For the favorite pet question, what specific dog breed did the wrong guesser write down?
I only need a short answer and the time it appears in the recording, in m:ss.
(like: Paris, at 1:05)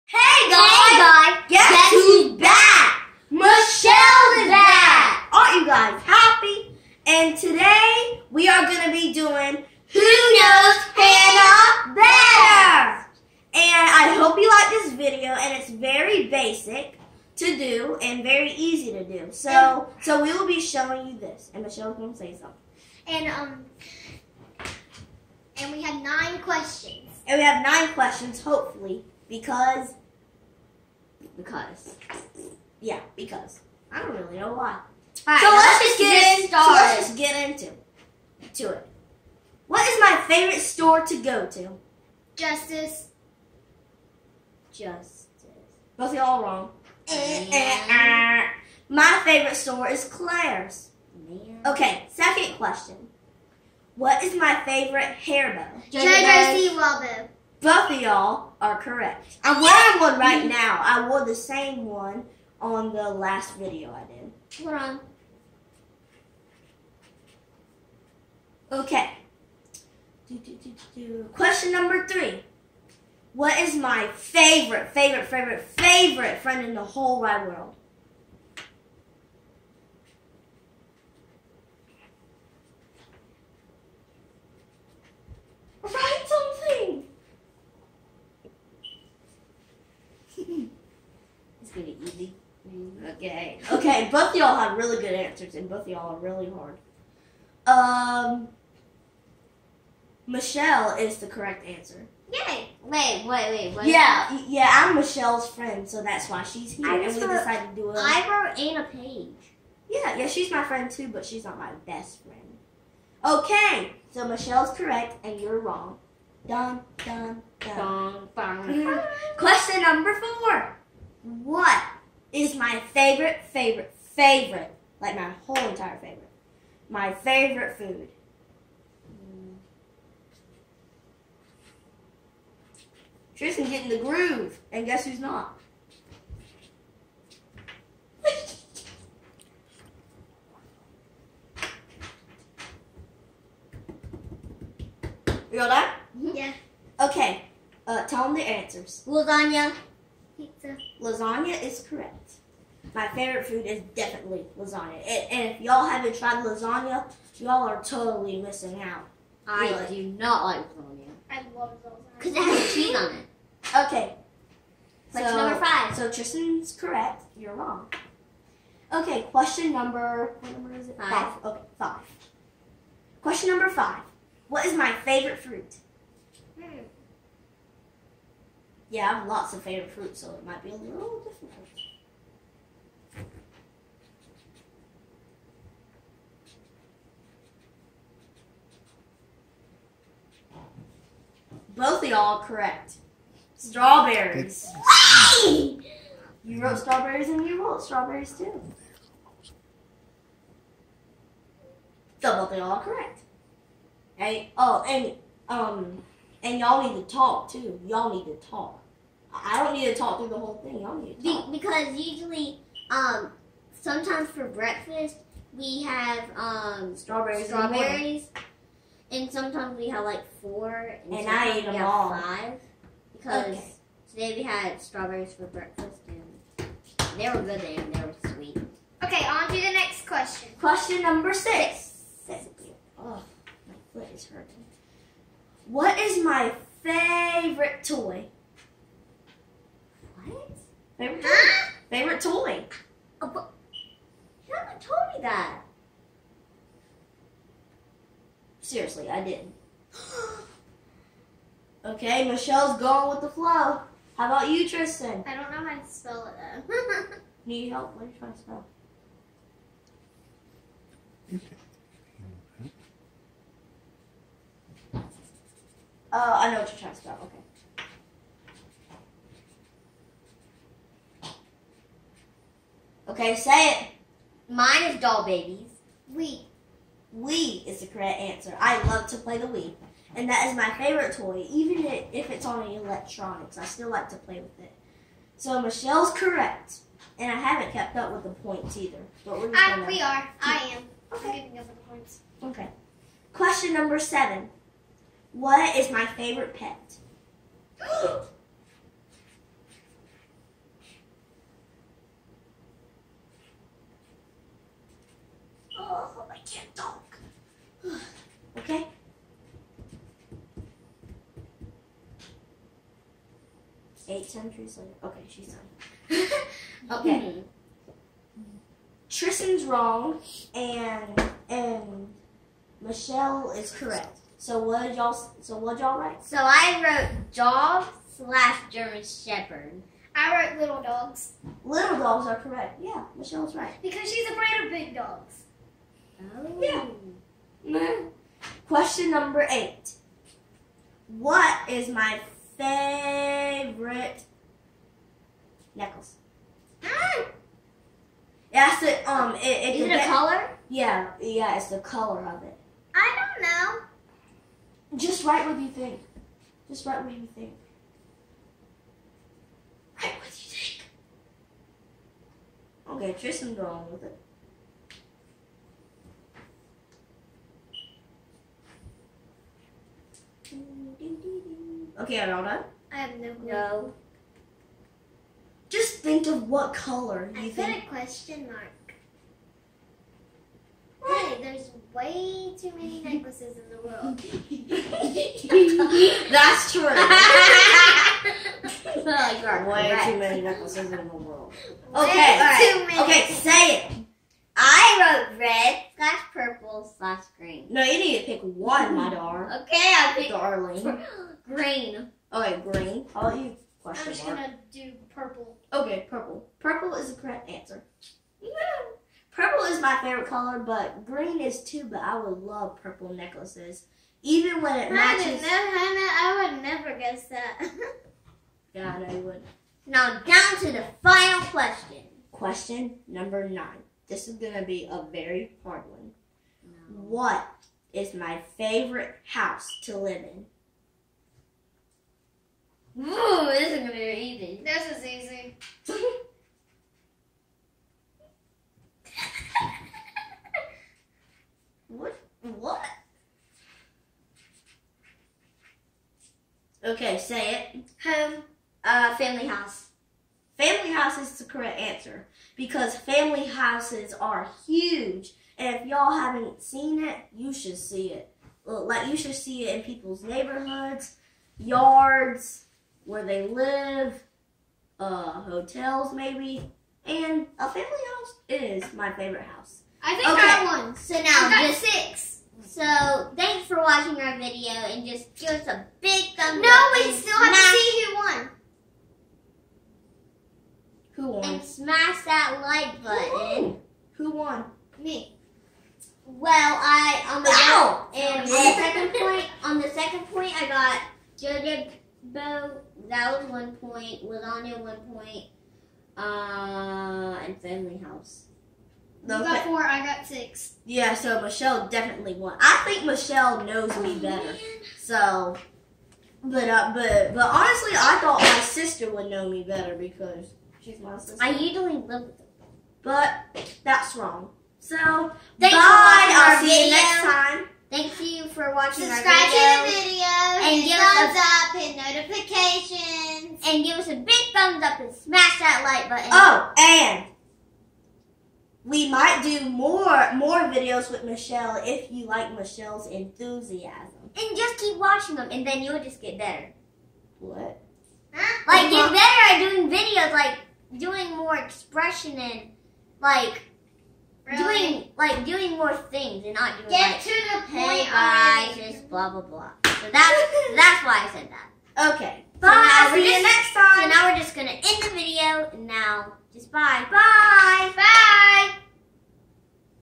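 German Shepherd, at 5:27.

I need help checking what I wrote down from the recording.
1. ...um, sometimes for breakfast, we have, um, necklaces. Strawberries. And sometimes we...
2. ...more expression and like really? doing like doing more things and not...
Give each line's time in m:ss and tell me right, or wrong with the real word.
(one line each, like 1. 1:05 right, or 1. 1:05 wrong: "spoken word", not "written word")
1. 3:32 wrong: "strawberries", not "necklaces"
2. 9:01 right.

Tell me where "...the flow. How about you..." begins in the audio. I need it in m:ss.
4:13.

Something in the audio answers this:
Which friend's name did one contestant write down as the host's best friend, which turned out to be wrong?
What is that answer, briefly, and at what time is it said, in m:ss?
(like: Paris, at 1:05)
Anna Page, at 1:47.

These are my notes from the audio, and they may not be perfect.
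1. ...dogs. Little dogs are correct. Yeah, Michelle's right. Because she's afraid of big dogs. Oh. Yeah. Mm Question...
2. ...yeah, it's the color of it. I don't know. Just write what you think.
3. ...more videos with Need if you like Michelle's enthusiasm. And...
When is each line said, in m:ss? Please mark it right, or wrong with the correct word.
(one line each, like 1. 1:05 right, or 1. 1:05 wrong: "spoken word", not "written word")
1. 5:30 right
2. 5:51 right
3. 8:50 wrong: "Michelle", not "Need".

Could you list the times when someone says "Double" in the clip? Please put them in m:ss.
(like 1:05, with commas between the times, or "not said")
3:22.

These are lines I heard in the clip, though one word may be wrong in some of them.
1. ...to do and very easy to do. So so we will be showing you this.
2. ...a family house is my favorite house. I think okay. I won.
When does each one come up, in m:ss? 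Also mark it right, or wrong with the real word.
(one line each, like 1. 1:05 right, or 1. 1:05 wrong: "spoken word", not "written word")
1. 0:17 right
2. 7:47 right.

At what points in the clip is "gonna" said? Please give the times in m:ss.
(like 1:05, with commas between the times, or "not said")
1:31, 6:44, 9:14.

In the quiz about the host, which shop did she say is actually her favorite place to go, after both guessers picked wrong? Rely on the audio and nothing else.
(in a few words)
Claire's.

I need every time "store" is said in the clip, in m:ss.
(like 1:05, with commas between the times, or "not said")
0:40, 0:49.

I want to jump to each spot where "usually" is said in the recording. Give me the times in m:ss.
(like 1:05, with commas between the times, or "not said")
3:31, 8:31.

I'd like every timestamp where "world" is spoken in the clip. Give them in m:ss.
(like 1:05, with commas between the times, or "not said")
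1:17, 6:23, 6:31.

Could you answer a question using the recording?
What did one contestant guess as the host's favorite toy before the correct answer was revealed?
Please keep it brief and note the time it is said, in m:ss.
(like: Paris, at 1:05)
Doll babies, at 4:34.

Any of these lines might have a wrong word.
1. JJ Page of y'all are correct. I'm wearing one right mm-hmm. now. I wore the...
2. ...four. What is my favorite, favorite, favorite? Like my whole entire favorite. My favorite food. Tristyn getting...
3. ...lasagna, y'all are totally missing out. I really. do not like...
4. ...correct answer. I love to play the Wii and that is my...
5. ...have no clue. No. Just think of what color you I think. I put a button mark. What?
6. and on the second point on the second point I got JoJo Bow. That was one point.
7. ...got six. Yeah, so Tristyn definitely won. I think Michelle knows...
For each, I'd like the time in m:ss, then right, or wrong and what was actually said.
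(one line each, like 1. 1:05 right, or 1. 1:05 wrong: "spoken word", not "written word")
1. 0:55 wrong: "Both", not "Page"
2. 2:00 right
3. 2:36 right
4. 4:37 right
5. 6:12 wrong: "question", not "button"
6. 8:08 right
7. 8:20 wrong: "Michelle", not "Tristyn".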